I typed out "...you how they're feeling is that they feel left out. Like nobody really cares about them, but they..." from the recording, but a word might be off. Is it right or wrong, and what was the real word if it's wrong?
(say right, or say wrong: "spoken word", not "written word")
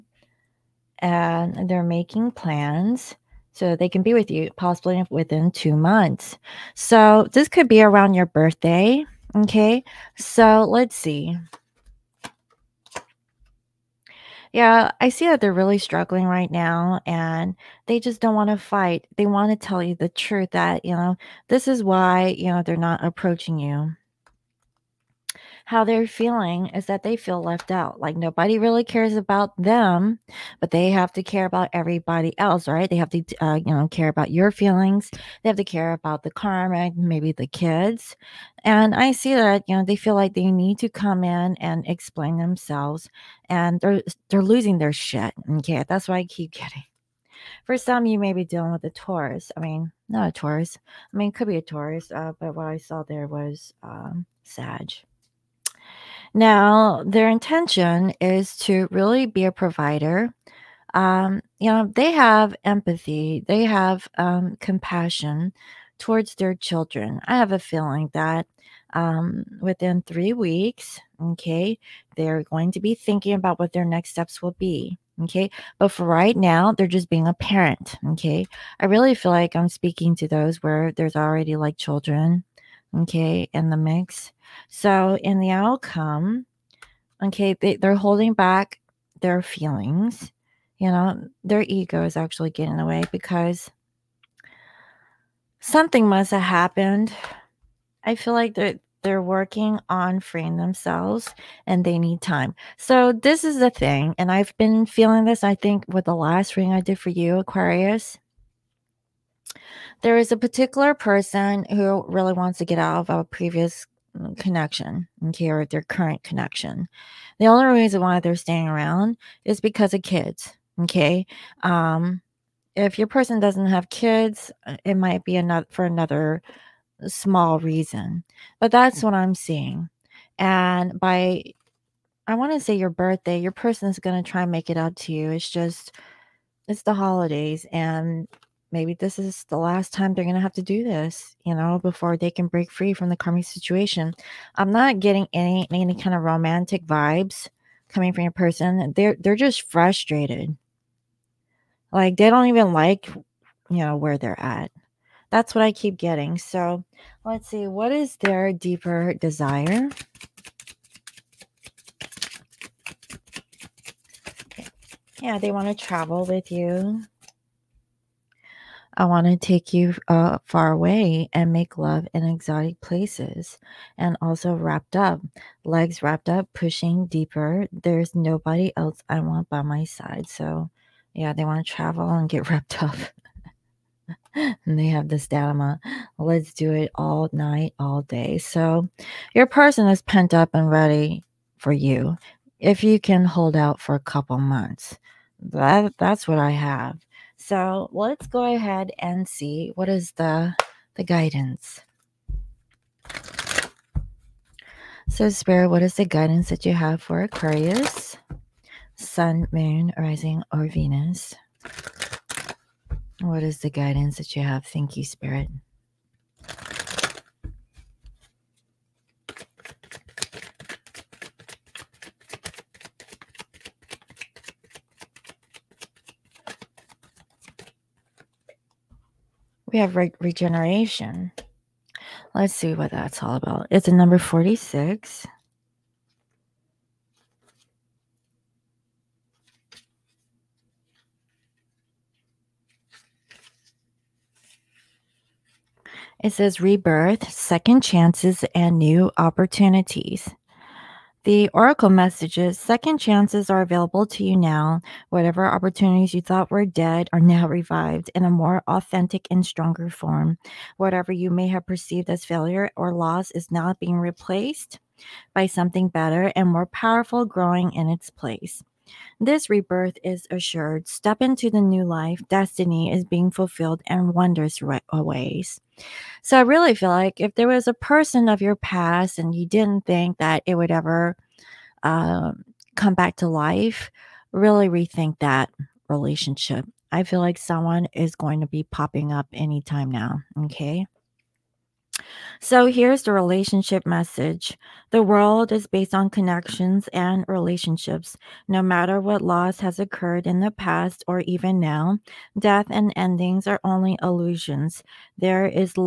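right.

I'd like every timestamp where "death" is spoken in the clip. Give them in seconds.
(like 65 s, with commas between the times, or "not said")
302 s.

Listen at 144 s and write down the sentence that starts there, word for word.
I'm not getting any any kind of romantic vibes coming from your person.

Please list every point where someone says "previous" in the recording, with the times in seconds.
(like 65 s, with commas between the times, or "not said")
113 s.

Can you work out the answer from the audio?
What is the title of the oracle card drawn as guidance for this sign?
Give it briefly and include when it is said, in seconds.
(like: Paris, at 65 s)
Regeneration, at 230 s.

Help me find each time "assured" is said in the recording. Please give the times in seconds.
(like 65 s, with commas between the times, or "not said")
270 s.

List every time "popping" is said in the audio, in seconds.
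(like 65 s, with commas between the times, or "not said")
288 s.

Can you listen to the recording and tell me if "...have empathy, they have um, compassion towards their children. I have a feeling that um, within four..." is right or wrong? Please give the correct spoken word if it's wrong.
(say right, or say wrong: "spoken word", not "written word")
wrong: "three", not "four".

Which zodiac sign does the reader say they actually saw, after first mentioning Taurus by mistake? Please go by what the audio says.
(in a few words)
Sag.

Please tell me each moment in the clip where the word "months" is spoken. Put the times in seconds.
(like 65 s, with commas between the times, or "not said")
5 s, 194 s.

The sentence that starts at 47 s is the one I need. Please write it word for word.
For some, you may be dealing with a Taurus.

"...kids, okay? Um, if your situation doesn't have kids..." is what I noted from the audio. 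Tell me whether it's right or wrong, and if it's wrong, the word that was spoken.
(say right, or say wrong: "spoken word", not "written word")
wrong: "person", not "situation".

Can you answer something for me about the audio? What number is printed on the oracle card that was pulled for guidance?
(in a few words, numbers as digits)
46.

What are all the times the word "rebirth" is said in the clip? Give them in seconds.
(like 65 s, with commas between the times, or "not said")
246 s, 269 s.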